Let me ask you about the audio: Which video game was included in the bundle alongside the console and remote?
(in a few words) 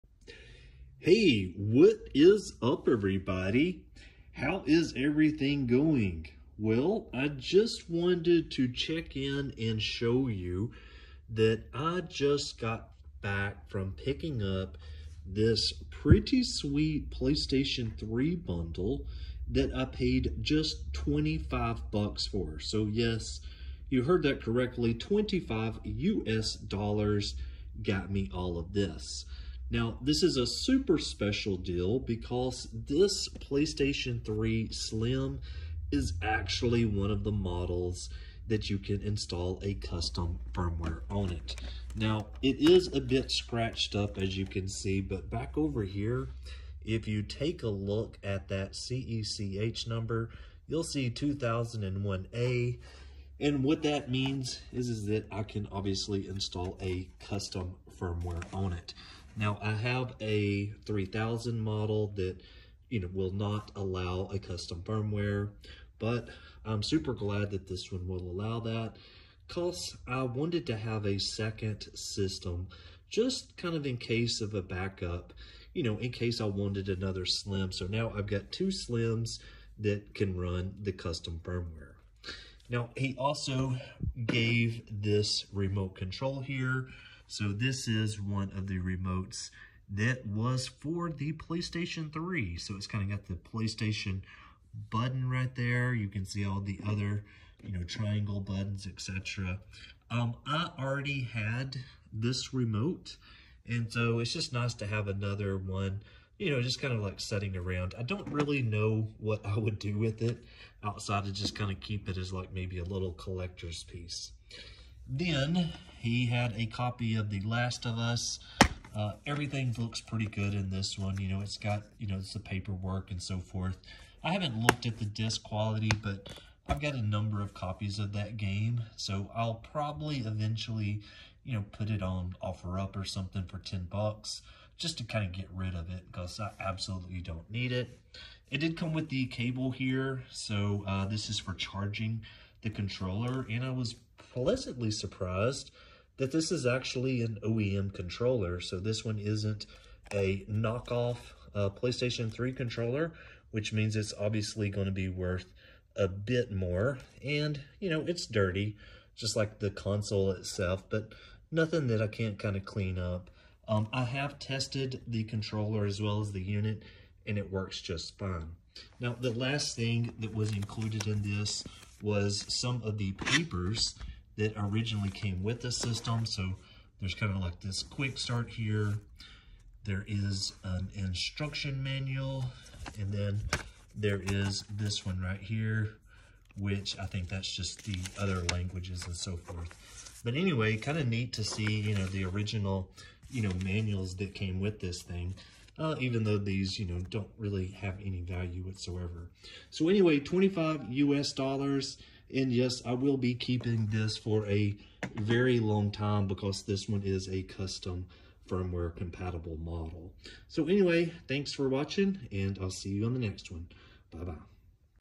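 The Last of Us.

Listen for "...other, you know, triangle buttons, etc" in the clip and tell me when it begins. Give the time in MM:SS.
01:36.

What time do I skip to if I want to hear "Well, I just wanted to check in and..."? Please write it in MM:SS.
00:06.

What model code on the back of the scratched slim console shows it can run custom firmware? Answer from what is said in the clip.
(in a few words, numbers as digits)
2001A.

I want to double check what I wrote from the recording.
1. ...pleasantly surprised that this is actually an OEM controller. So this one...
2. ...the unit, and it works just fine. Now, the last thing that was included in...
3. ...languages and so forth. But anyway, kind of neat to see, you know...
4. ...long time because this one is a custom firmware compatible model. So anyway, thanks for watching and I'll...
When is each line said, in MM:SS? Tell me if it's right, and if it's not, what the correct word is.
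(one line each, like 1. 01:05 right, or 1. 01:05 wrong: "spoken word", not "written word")
1. 02:24 right
2. 02:46 right
3. 03:08 right
4. 03:25 right.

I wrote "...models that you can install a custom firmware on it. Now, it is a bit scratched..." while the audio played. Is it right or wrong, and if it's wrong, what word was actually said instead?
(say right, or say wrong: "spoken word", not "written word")
right.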